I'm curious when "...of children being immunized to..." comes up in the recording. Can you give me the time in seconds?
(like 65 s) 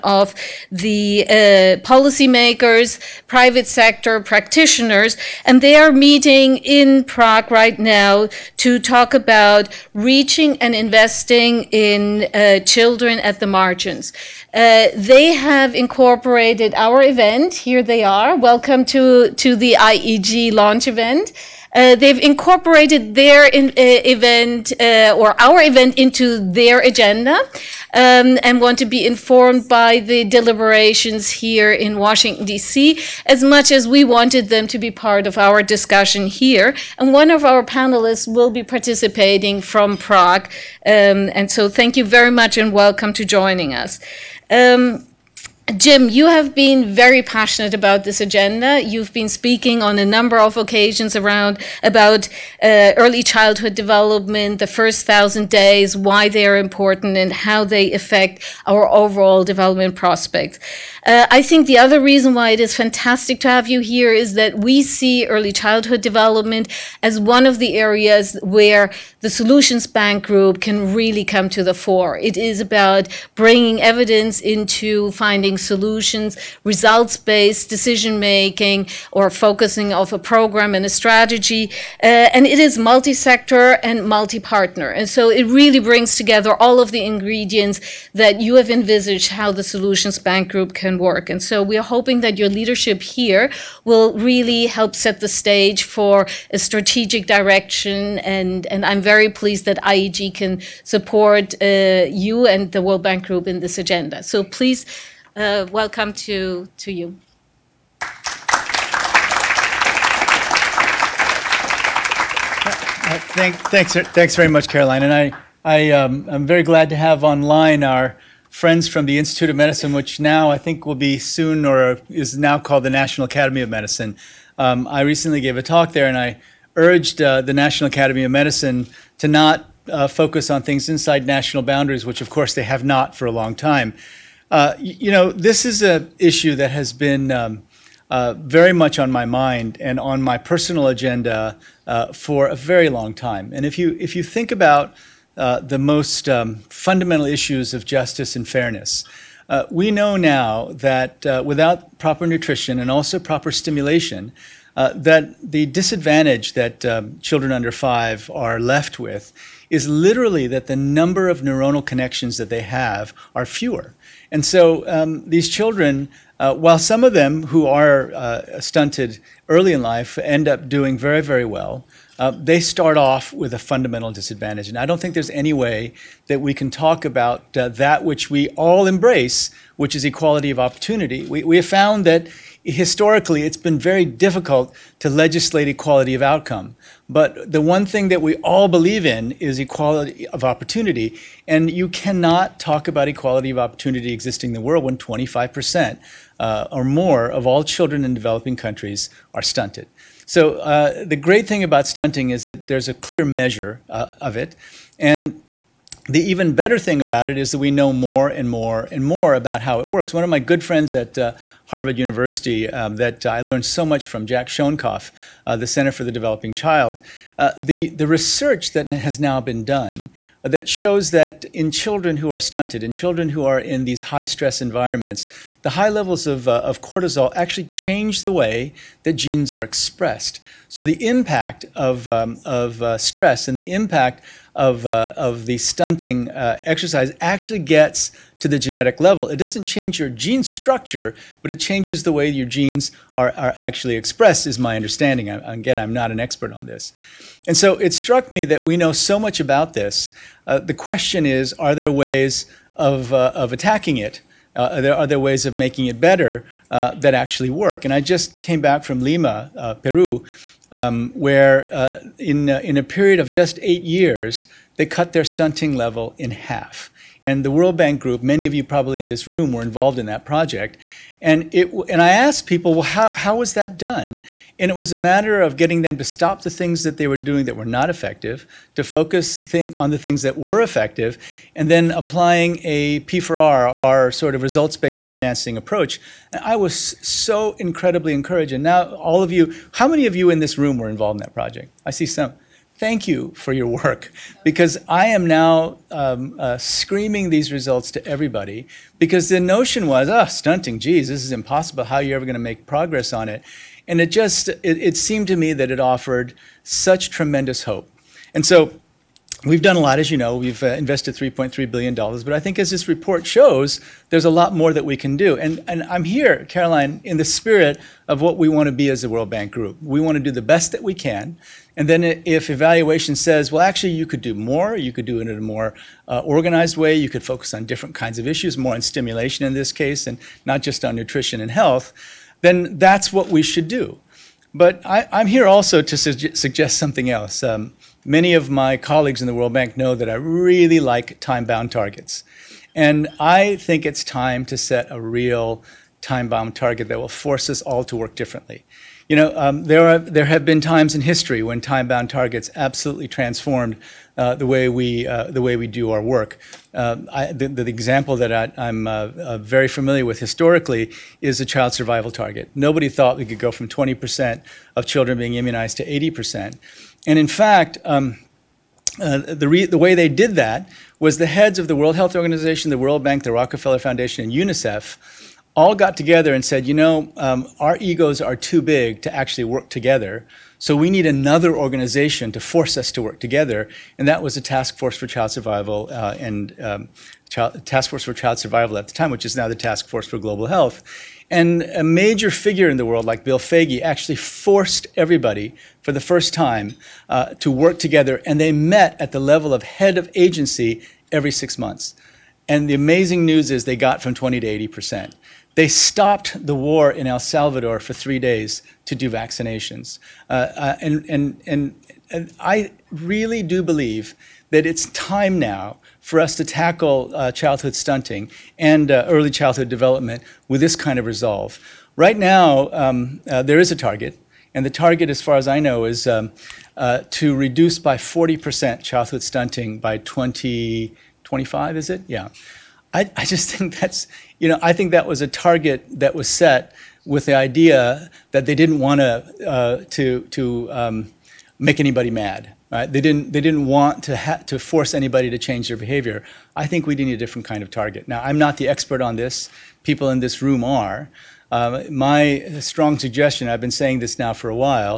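364 s.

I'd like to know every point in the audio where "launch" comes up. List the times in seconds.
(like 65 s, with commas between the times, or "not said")
20 s.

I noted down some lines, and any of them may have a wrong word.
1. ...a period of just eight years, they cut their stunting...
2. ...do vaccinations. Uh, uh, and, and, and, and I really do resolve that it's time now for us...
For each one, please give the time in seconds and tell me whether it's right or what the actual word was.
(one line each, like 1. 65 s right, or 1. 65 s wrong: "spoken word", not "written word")
1. 262 s right
2. 408 s wrong: "believe", not "resolve".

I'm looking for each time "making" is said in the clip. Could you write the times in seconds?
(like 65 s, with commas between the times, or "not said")
78 s, 255 s.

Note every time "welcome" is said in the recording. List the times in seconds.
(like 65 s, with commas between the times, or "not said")
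18 s, 42 s, 105 s.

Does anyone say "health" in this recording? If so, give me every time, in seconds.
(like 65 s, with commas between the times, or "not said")
331 s, 371 s, 390 s.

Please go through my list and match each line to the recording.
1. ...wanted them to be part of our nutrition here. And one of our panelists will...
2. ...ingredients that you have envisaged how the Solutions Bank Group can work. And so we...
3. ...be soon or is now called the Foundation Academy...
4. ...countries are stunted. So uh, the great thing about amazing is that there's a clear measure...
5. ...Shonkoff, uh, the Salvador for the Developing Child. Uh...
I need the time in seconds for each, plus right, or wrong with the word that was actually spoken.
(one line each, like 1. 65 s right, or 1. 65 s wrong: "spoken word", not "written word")
1. 34 s wrong: "discussion", not "nutrition"
2. 87 s right
3. 120 s wrong: "National", not "Foundation"
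4. 198 s wrong: "stunting", not "amazing"
5. 214 s wrong: "Center", not "Salvador".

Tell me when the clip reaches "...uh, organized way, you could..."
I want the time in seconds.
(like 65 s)
326 s.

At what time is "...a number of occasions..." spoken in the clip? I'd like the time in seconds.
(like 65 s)
49 s.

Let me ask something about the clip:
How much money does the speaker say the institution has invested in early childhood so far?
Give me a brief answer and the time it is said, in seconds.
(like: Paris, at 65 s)
$3.3 billion, at 311 s.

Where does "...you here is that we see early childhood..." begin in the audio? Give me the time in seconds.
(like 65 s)
63 s.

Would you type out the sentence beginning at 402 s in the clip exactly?
And the amazing news is they got from 20 to 80 percent.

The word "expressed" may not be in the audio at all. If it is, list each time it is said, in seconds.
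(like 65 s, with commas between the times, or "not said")
229 s, 243 s.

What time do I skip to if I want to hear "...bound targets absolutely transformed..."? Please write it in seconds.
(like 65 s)
351 s.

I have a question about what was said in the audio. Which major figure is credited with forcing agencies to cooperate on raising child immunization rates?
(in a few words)
Bill Foege.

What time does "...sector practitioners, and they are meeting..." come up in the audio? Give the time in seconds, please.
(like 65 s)
3 s.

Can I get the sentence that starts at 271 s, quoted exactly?
And, it, and I asked people, well, how, how was that done?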